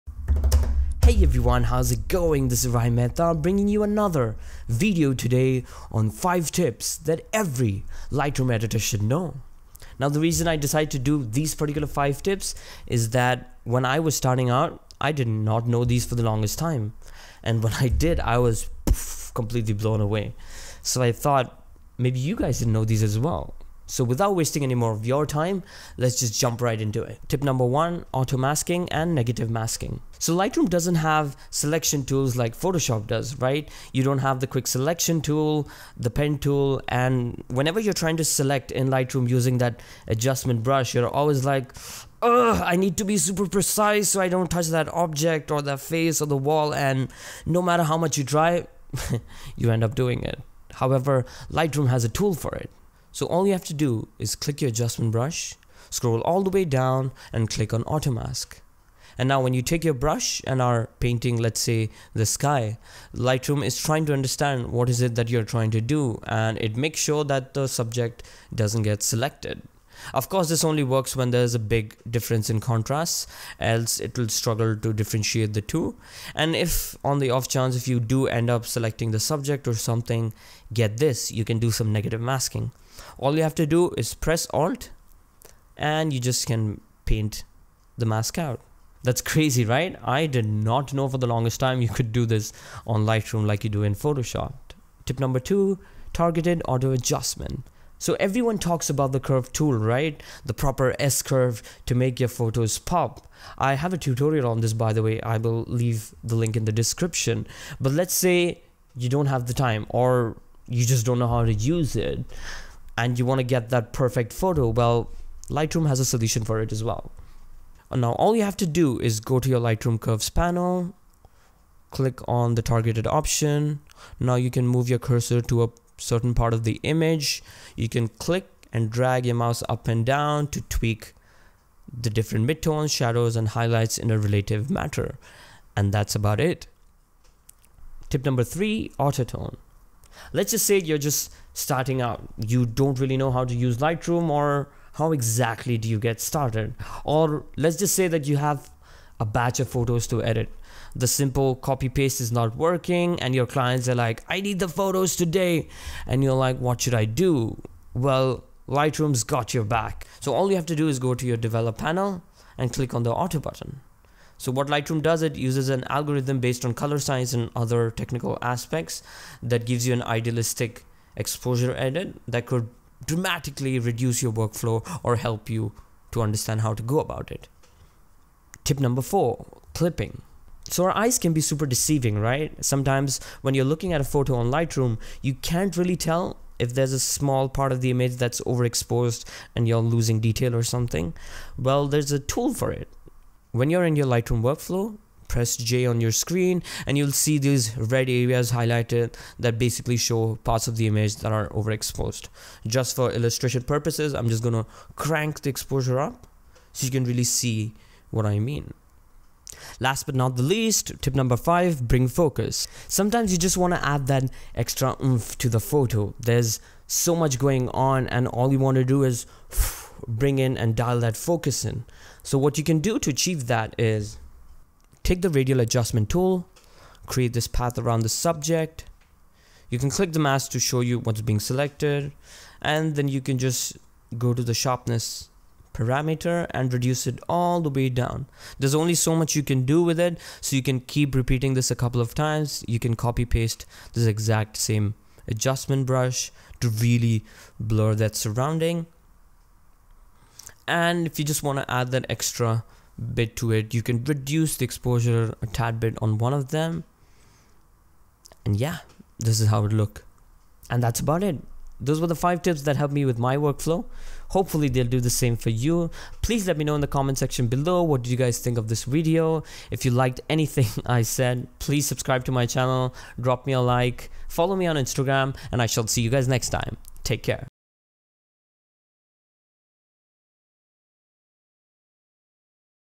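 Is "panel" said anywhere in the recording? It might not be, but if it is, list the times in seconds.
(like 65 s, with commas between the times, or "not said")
120 s, 161 s.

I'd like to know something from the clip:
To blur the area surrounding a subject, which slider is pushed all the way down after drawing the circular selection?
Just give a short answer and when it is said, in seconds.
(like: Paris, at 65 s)
Sharpness, at 234 s.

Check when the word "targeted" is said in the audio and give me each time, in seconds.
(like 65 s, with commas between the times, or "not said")
96 s, 122 s.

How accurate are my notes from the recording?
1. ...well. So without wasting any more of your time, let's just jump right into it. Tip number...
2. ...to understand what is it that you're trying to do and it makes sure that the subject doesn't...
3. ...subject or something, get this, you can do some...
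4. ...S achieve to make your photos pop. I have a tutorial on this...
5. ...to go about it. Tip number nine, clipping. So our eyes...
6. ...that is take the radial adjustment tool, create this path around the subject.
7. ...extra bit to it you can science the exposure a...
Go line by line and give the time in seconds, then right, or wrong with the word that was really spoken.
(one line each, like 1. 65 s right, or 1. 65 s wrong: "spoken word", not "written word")
1. 23 s right
2. 64 s right
3. 79 s right
4. 100 s wrong: "curve", not "achieve"
5. 176 s wrong: "four", not "nine"
6. 223 s right
7. 252 s wrong: "reduce", not "science".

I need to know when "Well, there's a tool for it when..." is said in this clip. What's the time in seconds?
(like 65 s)
191 s.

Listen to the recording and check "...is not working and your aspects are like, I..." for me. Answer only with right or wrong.
wrong.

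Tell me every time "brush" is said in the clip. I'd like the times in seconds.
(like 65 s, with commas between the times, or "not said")
40 s, 55 s, 59 s, 245 s.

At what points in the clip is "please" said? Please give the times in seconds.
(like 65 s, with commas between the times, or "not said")
266 s, 271 s.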